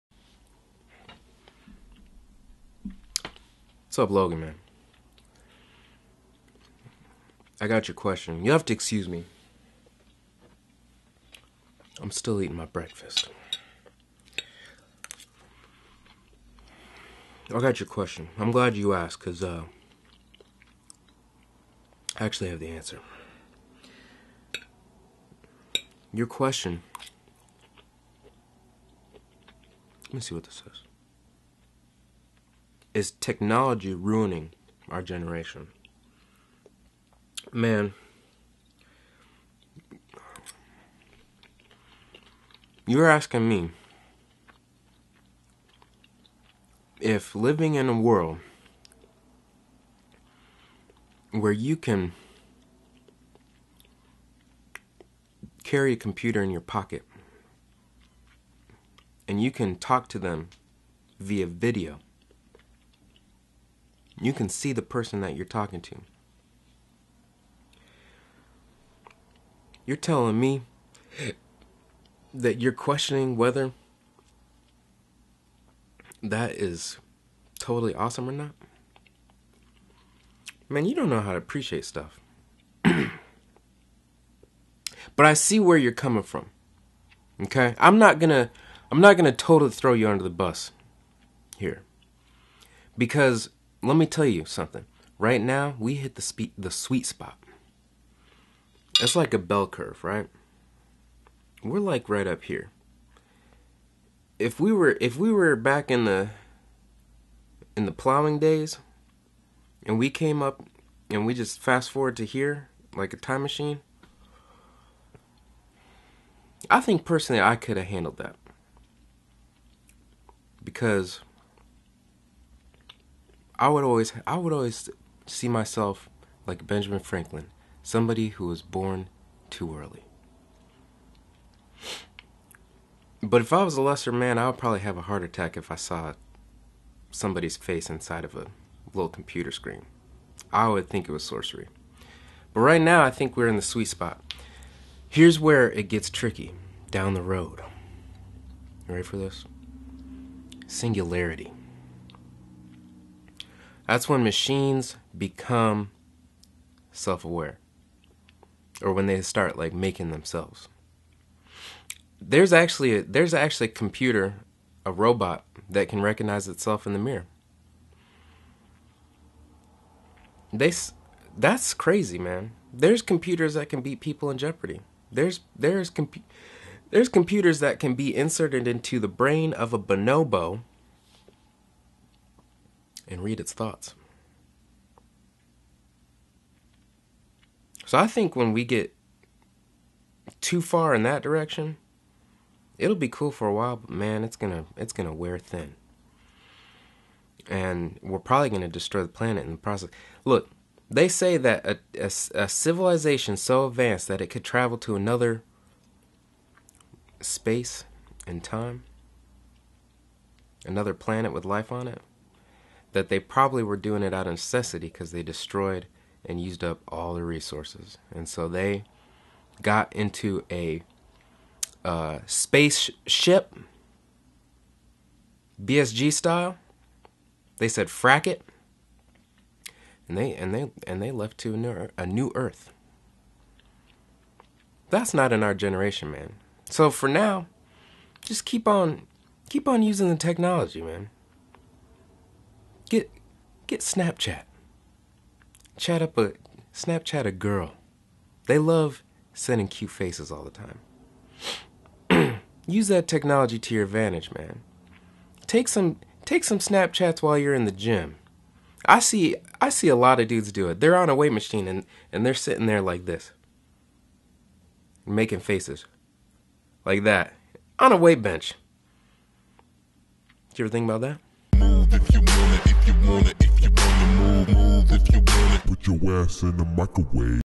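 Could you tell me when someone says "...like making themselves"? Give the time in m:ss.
2:39.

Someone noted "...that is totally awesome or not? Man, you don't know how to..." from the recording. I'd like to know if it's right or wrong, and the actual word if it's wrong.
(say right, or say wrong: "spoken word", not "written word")
right.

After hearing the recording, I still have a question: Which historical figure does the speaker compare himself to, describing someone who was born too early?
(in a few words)
Benjamin Franklin.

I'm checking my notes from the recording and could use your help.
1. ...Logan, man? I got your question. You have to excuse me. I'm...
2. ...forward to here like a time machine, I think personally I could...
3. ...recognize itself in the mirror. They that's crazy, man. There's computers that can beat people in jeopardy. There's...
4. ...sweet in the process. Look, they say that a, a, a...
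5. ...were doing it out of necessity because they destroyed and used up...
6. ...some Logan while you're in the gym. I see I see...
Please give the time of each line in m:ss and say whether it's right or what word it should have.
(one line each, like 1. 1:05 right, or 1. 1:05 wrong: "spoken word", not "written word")
1. 0:04 right
2. 1:51 right
3. 2:46 right
4. 3:19 wrong: "planet", not "sweet"
5. 3:33 right
6. 4:16 wrong: "Snapchats", not "Logan".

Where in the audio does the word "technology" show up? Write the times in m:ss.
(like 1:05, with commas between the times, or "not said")
0:33, 4:00, 4:13.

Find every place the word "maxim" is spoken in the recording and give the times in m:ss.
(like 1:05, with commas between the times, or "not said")
not said.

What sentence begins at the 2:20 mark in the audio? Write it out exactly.
I would think it was sorcery.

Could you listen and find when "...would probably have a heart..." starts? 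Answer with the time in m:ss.
2:14.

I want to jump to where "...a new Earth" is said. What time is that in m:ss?
3:51.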